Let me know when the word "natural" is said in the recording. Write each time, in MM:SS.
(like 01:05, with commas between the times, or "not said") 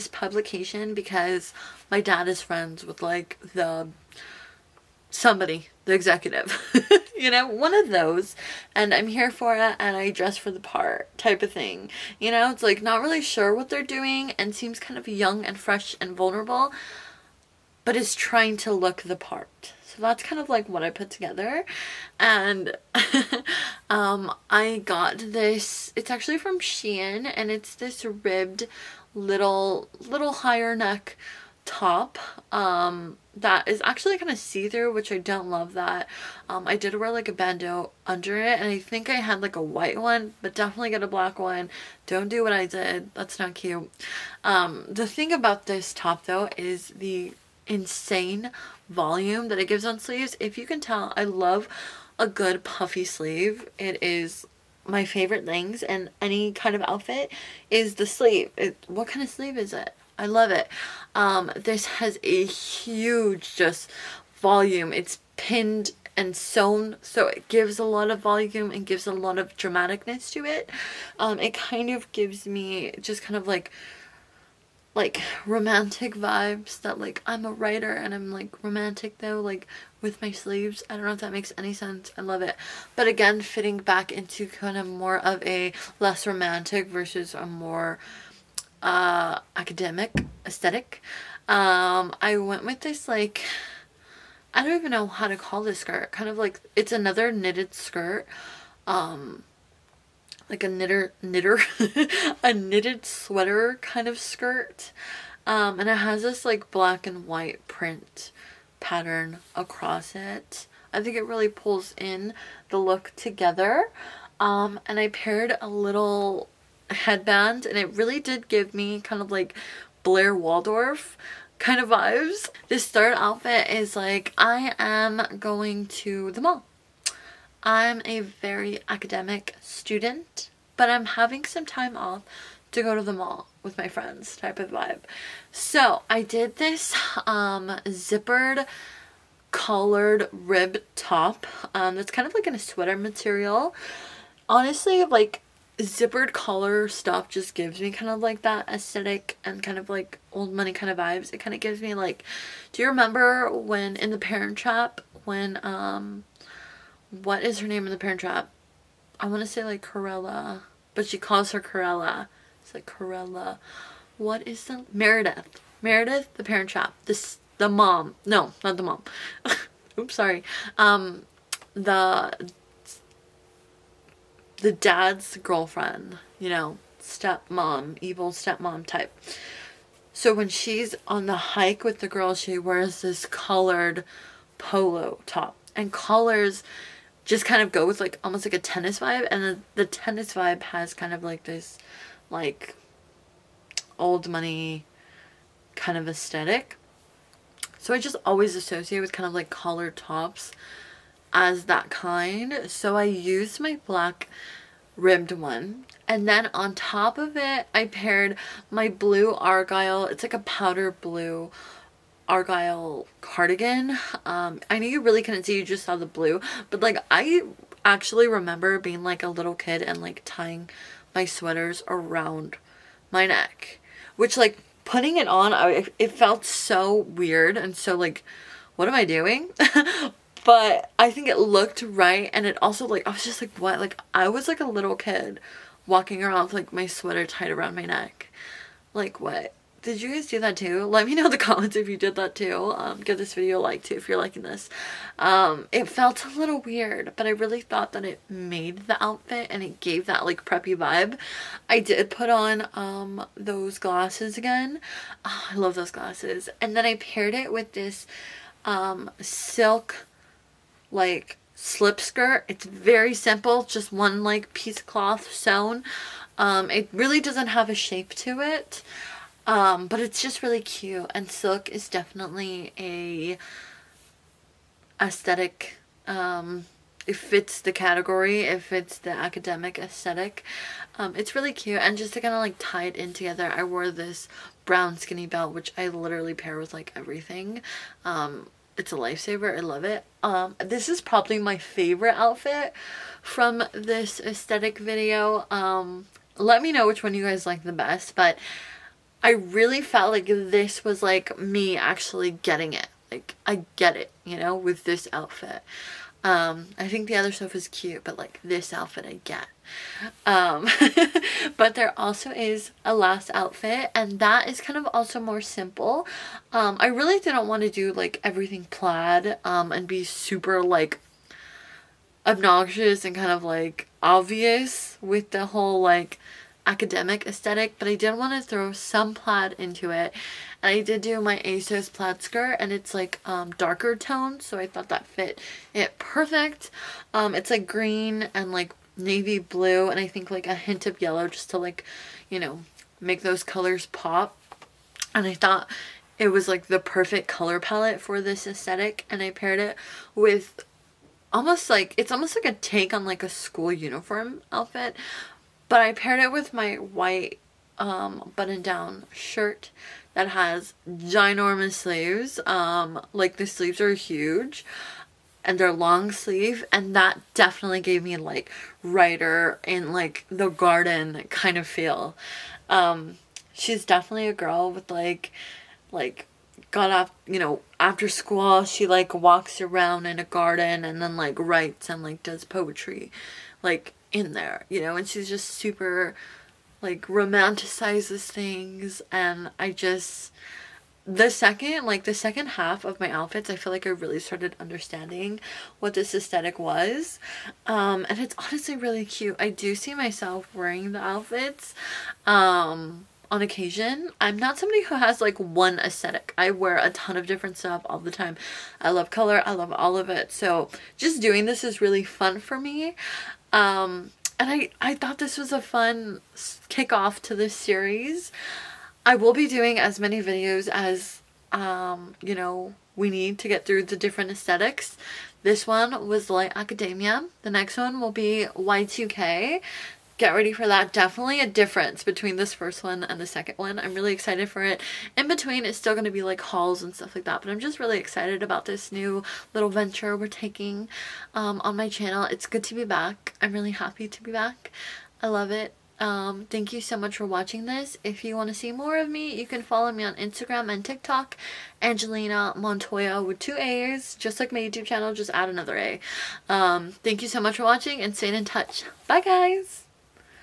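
not said.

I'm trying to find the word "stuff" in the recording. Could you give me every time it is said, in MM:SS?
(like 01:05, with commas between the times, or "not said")
02:26, 05:07, 06:47, 07:16.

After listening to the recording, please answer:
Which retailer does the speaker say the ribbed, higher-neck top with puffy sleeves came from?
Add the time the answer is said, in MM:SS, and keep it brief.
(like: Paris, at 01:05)
Shein, at 00:26.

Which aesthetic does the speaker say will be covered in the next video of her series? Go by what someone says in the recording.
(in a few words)
Y2K.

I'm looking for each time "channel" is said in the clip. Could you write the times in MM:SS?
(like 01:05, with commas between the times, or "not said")
07:21, 07:34.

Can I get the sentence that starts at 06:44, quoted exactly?
I'm not somebody who has like one aesthetic.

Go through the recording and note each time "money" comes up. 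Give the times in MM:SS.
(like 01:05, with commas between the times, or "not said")
02:30, 03:14.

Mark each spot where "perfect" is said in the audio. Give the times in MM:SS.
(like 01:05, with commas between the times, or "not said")
05:35, 05:46.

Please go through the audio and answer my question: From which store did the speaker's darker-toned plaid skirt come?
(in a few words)
ASOS.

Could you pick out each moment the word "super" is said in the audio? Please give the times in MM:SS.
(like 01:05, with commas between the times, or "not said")
05:20, 06:25.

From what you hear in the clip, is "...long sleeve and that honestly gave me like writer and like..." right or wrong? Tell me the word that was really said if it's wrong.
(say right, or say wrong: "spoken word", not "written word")
wrong: "definitely", not "honestly".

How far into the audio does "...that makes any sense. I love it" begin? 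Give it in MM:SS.
01:21.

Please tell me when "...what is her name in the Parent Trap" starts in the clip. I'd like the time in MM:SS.
02:37.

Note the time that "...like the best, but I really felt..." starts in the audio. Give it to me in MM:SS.
04:57.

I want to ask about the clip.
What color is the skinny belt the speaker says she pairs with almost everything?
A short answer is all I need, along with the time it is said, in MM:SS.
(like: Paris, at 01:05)
Brown, at 04:44.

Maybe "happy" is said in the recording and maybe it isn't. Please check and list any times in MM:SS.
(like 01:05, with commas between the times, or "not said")
07:23.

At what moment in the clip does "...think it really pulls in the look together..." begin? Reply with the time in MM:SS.
01:51.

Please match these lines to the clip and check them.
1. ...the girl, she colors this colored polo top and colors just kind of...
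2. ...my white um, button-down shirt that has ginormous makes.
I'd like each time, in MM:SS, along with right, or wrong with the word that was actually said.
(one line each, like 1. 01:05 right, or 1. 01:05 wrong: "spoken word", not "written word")
1. 03:01 wrong: "wears", not "colors"
2. 05:56 wrong: "sleeves", not "makes".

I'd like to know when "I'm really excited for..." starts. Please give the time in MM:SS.
07:13.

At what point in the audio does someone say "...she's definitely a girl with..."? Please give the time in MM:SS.
06:13.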